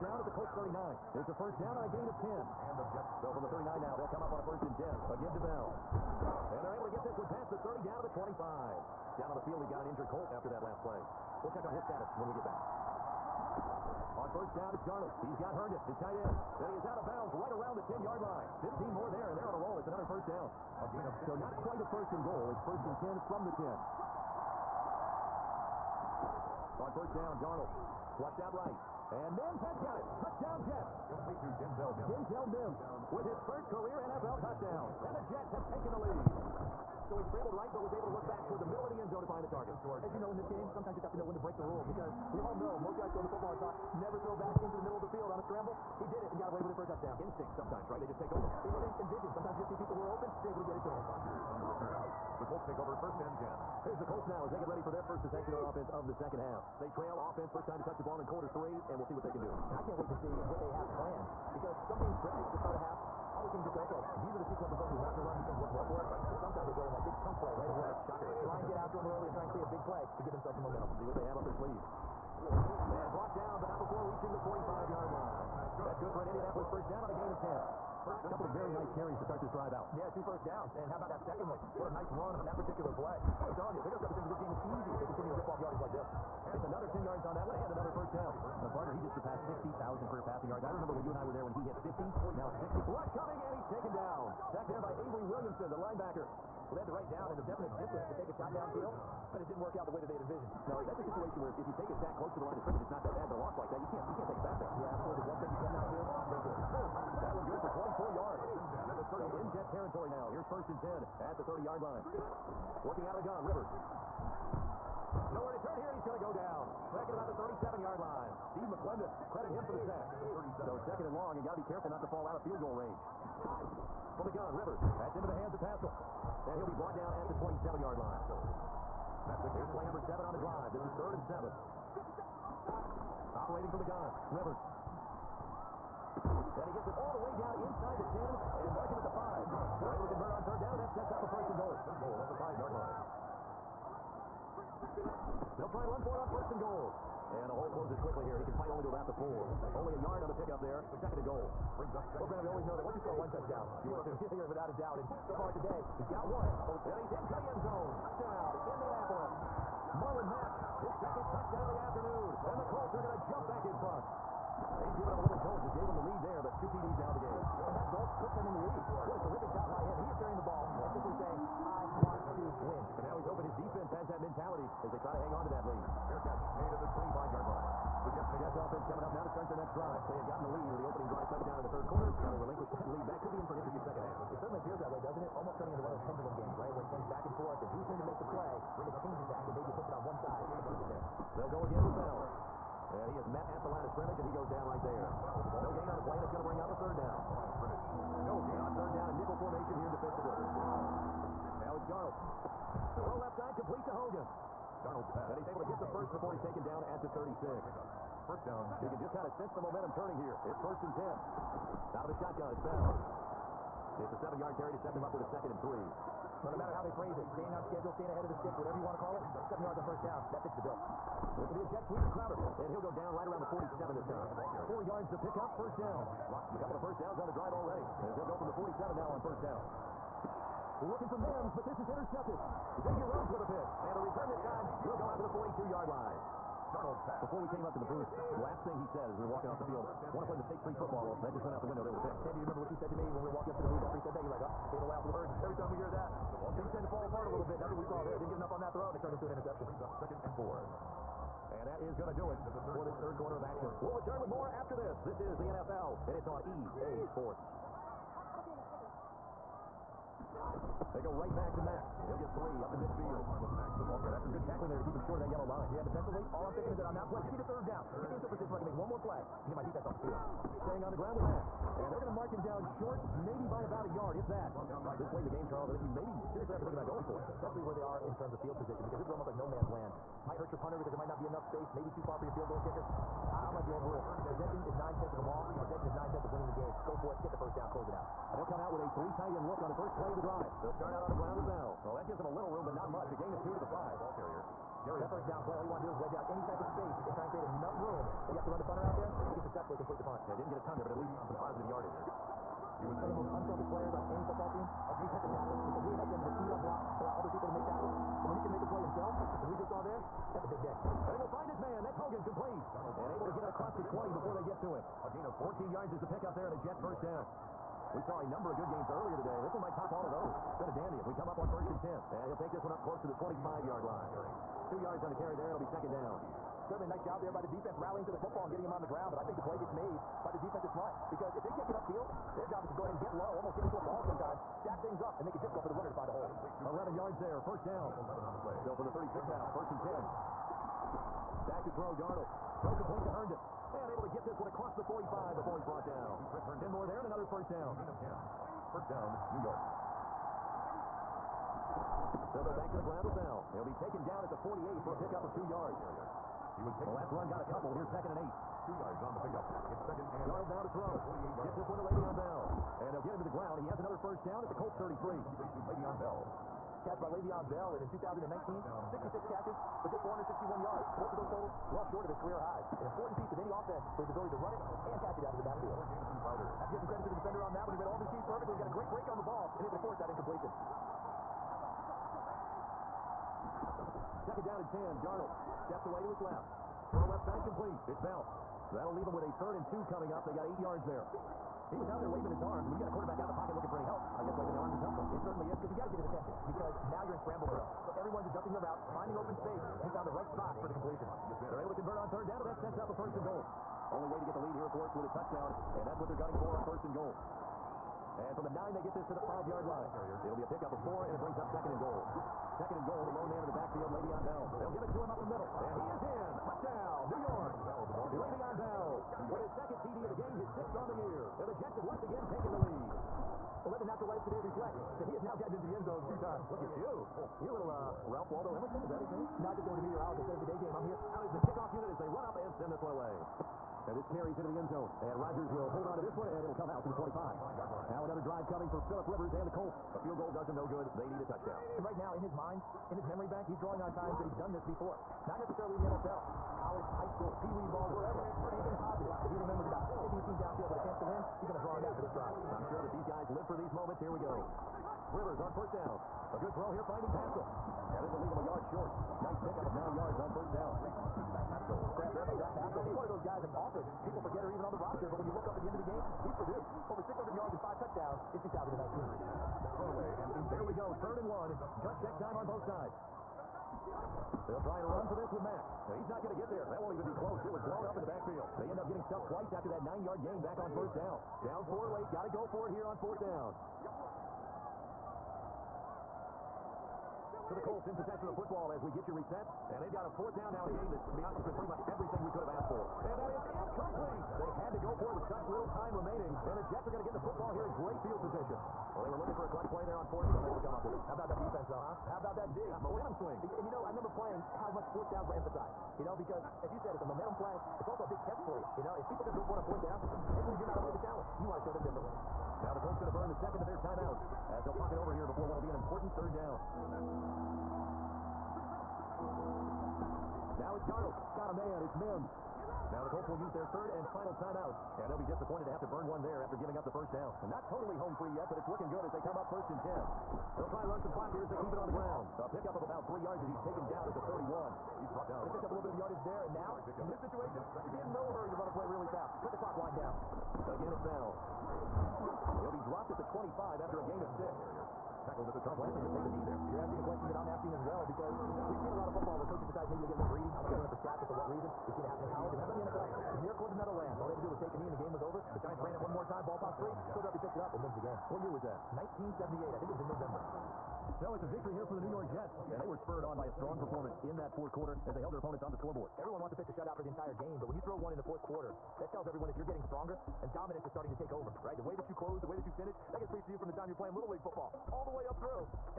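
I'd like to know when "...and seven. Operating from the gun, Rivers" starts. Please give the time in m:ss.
2:11.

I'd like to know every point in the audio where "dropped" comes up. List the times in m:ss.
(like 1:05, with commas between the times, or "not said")
9:02.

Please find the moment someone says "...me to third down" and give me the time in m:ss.
4:27.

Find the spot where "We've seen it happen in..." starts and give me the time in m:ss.
9:11.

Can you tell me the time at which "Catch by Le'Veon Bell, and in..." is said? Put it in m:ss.
6:06.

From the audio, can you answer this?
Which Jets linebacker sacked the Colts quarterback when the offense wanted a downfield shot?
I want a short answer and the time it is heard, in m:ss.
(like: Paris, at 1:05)
Avery Williamson, at 1:35.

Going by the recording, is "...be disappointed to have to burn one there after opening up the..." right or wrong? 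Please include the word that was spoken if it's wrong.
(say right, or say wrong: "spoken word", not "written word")
wrong: "giving", not "opening".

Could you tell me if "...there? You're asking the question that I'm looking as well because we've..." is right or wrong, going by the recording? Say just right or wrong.
wrong.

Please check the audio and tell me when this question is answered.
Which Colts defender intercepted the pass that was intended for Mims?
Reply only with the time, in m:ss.
3:52.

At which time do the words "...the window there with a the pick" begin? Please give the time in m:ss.
4:01.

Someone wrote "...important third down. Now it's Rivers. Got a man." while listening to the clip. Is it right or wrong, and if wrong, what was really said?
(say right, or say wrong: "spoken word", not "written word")
wrong: "Darnold", not "Rivers".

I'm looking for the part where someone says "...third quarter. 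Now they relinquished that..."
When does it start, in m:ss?
3:01.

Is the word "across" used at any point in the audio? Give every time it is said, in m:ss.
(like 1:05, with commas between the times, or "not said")
5:13, 5:44.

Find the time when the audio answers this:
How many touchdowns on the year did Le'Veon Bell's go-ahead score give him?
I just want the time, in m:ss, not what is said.
7:00.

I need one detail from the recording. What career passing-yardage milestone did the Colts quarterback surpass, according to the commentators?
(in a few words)
60,000.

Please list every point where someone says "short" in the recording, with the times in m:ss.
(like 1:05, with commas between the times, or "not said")
4:24, 4:32, 6:11, 7:38.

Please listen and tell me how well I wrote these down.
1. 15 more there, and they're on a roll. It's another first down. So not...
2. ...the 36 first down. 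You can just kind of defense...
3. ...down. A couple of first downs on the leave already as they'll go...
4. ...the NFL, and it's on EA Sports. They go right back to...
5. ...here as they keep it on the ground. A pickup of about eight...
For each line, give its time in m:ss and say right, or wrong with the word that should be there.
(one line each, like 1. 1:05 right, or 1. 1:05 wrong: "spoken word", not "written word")
1. 0:18 right
2. 3:27 wrong: "sense", not "defense"
3. 3:45 wrong: "drive", not "leave"
4. 4:15 right
5. 8:51 wrong: "three", not "eight".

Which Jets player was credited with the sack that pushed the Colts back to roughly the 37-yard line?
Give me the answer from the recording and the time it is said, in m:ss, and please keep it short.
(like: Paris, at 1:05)
Steve McLendon, at 1:58.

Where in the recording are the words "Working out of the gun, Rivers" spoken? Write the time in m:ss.
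1:52.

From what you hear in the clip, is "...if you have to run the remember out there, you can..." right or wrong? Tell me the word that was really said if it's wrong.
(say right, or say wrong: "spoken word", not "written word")
wrong: "punter", not "remember".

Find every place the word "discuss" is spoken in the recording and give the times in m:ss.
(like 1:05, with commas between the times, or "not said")
not said.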